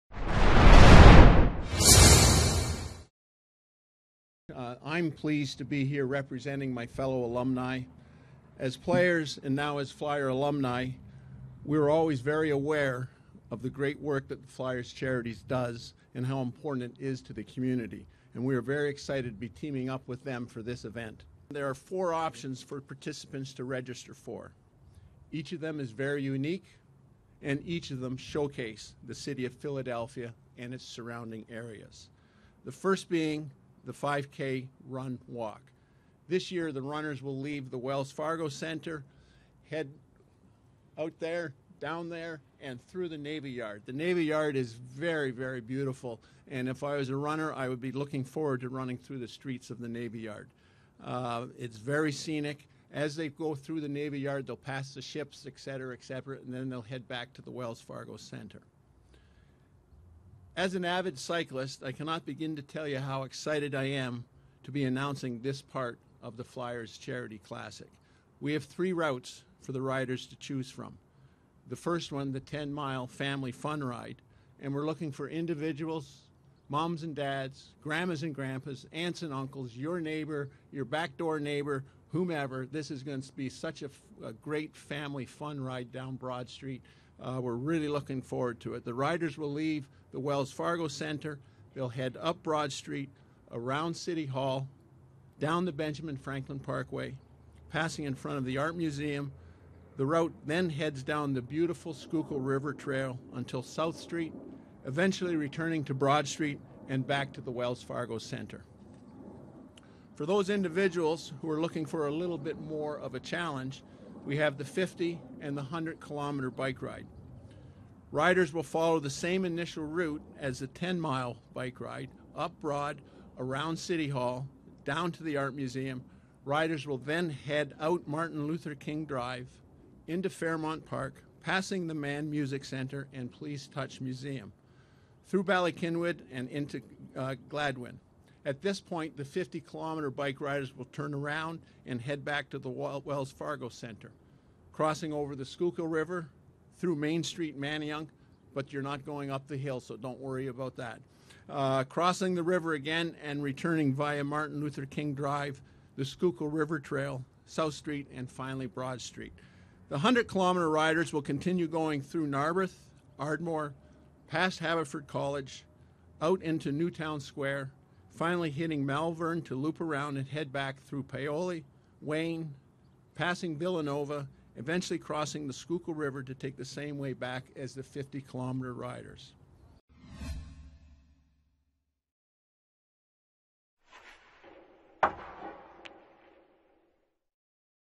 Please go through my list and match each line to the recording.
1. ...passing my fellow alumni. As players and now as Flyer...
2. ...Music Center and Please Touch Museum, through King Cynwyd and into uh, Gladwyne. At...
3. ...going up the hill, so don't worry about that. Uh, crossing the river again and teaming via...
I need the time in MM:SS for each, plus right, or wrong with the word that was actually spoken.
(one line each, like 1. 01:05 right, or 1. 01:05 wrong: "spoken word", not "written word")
1. 00:06 wrong: "representing", not "passing"
2. 02:12 wrong: "Bala", not "King"
3. 02:29 wrong: "returning", not "teaming".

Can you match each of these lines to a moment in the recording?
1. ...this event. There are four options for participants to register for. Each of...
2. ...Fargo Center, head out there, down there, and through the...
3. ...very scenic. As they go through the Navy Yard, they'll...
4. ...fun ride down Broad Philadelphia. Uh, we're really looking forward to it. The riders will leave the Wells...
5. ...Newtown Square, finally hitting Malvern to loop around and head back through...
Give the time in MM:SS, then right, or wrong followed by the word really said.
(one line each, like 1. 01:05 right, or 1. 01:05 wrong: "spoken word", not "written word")
1. 00:20 right
2. 00:38 right
3. 00:51 right
4. 01:25 wrong: "Street", not "Philadelphia"
5. 02:46 right.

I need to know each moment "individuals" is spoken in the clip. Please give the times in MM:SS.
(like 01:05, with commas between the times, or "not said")
01:15, 01:50.